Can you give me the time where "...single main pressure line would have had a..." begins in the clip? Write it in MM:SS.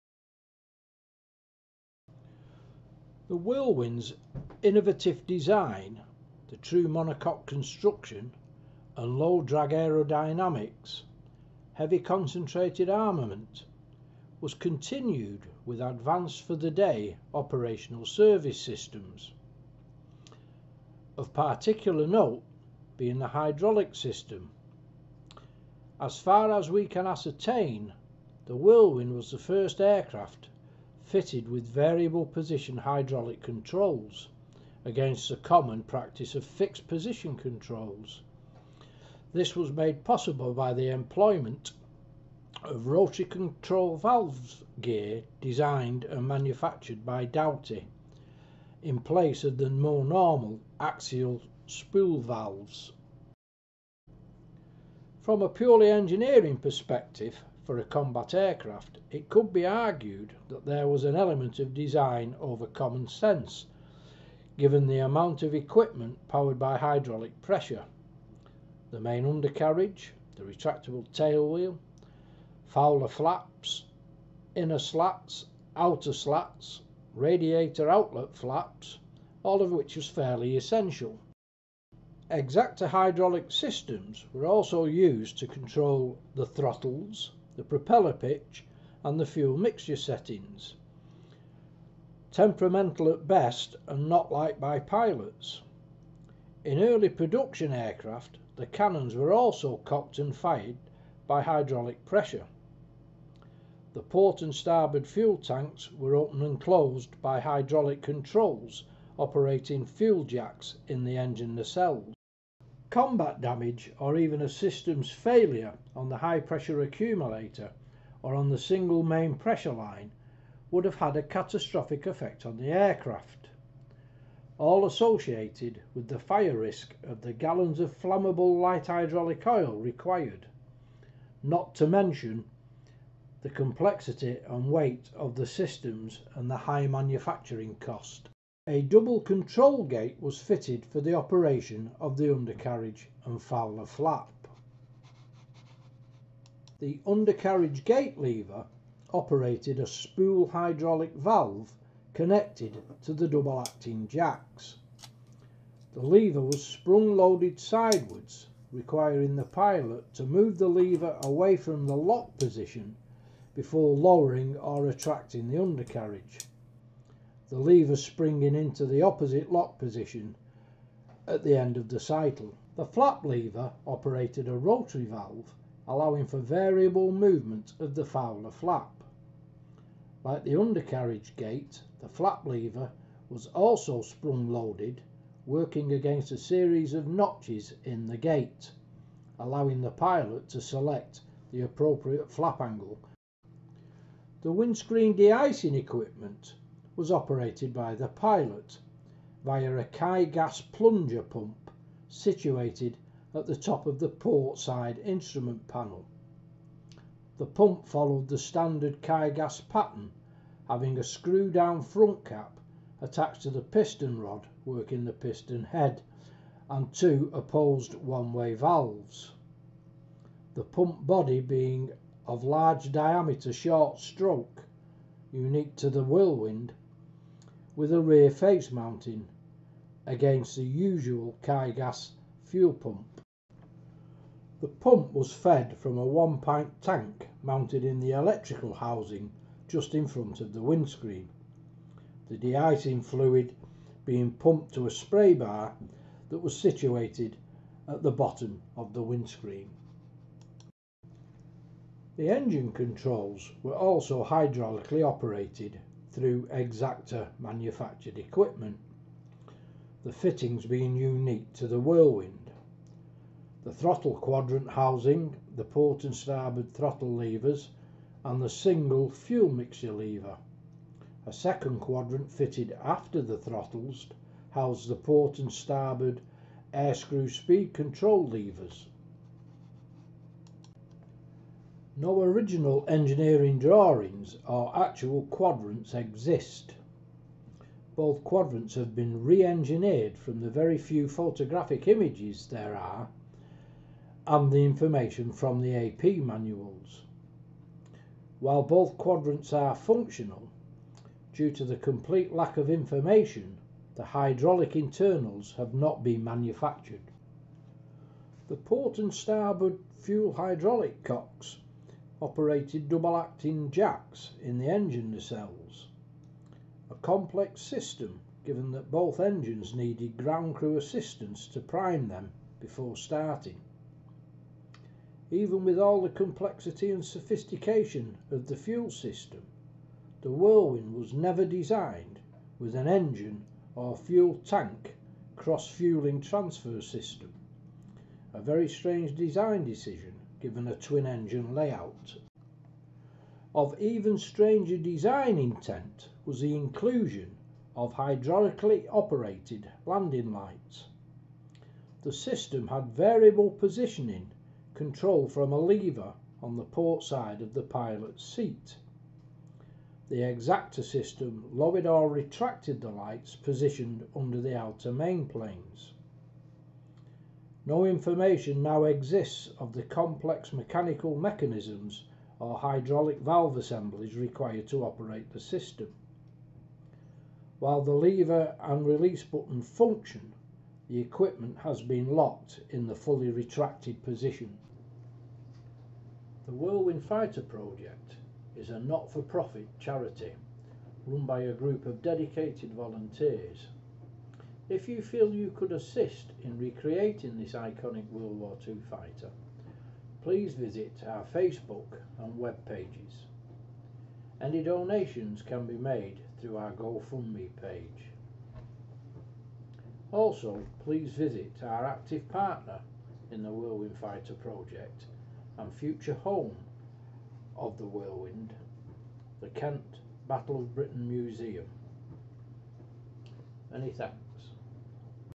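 01:58.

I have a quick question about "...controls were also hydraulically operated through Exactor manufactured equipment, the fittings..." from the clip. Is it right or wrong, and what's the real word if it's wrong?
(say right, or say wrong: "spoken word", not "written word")
right.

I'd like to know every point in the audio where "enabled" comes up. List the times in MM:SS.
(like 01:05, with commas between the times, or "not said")
not said.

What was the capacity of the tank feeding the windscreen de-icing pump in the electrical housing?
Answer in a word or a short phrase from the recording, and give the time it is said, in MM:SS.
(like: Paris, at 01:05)
One pint, at 03:56.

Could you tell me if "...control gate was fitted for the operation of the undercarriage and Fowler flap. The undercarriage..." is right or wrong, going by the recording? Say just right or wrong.
right.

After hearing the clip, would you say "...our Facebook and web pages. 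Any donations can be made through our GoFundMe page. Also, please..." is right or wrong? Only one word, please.
right.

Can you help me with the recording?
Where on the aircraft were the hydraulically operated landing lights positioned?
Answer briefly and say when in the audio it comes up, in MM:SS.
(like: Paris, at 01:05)
Under the outer main planes, at 06:04.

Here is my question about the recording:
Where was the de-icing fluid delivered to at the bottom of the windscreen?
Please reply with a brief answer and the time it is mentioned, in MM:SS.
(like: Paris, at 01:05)
A spray bar, at 04:04.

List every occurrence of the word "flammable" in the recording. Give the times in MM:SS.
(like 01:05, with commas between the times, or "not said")
02:08.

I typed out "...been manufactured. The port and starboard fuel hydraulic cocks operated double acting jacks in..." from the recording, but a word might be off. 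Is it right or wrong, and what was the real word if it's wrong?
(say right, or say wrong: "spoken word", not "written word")
right.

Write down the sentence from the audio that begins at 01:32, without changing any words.
Temperamental at best and not liked by pilots.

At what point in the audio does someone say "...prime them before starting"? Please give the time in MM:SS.
05:21.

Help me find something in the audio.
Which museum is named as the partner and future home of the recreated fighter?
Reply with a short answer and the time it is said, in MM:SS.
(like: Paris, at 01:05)
Kent Battle of Britain Museum, at 06:59.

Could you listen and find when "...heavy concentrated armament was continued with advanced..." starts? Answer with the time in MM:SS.
00:11.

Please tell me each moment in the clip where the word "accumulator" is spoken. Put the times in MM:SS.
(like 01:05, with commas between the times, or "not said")
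01:56.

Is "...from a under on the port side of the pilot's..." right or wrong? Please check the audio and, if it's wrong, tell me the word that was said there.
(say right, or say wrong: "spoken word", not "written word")
wrong: "lever", not "under".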